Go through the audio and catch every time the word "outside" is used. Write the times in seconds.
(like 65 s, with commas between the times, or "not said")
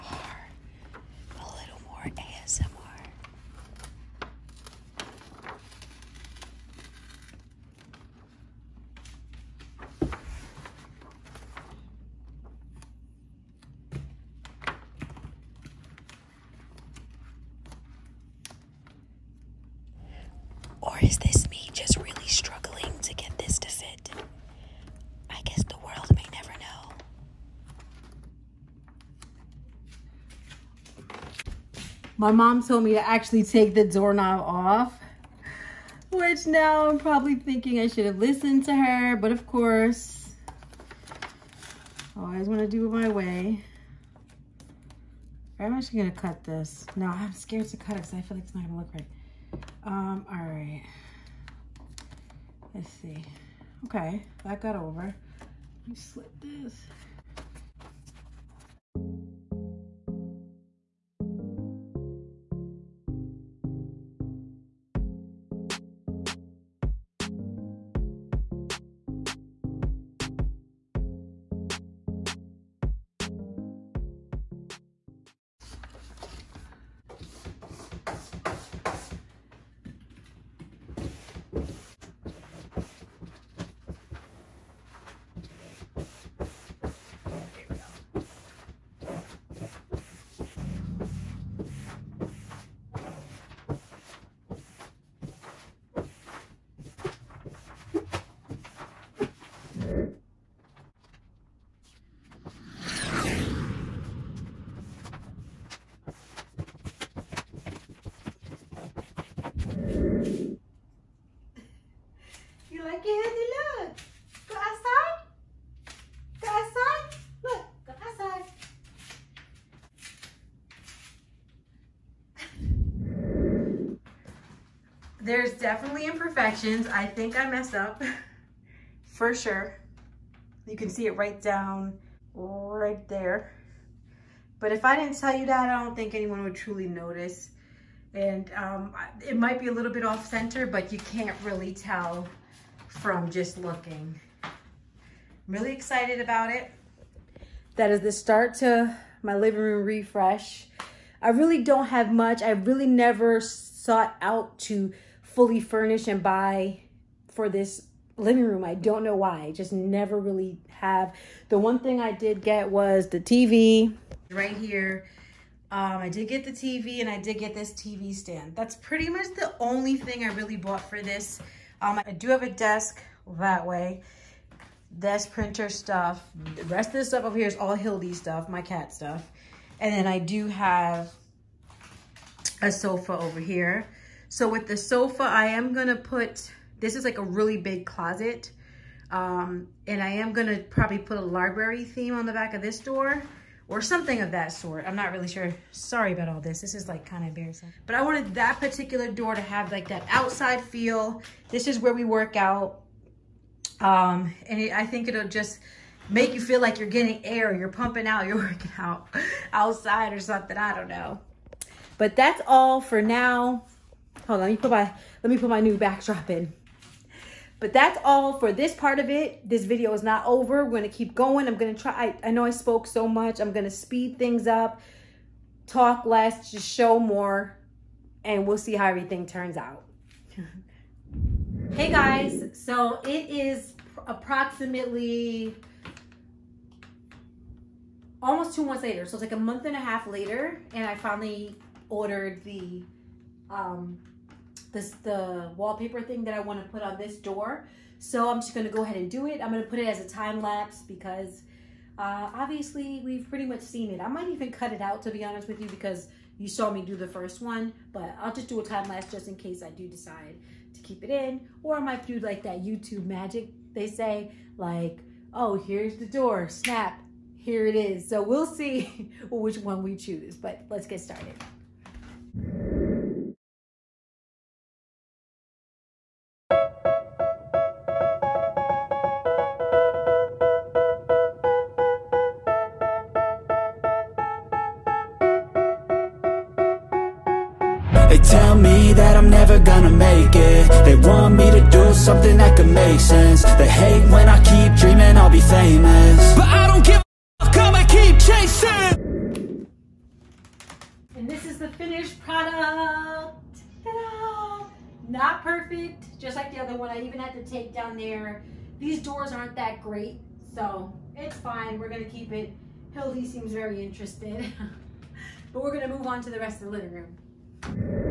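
200 s, 209 s.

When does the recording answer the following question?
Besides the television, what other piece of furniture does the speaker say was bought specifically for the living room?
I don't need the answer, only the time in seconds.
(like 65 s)
167 s.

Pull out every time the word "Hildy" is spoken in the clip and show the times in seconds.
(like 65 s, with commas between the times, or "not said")
177 s, 312 s.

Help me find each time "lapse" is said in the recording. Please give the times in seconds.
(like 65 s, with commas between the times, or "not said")
250 s, 258 s.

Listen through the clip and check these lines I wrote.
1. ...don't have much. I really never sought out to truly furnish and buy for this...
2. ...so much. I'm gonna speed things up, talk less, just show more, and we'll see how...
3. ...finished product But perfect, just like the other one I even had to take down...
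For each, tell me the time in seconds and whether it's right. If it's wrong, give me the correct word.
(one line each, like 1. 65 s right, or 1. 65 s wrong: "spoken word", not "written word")
1. 151 s wrong: "fully", not "truly"
2. 222 s right
3. 301 s wrong: "Not", not "But".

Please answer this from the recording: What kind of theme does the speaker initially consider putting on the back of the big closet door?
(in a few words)
Library theme.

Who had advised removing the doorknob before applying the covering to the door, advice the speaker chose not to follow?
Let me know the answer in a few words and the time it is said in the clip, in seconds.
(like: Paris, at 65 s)
Mom, at 32 s.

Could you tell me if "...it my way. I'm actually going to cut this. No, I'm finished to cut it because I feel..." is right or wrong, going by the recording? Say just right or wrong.
wrong.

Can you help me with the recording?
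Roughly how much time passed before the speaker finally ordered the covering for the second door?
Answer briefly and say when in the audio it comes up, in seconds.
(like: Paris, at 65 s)
A month and a half, at 239 s.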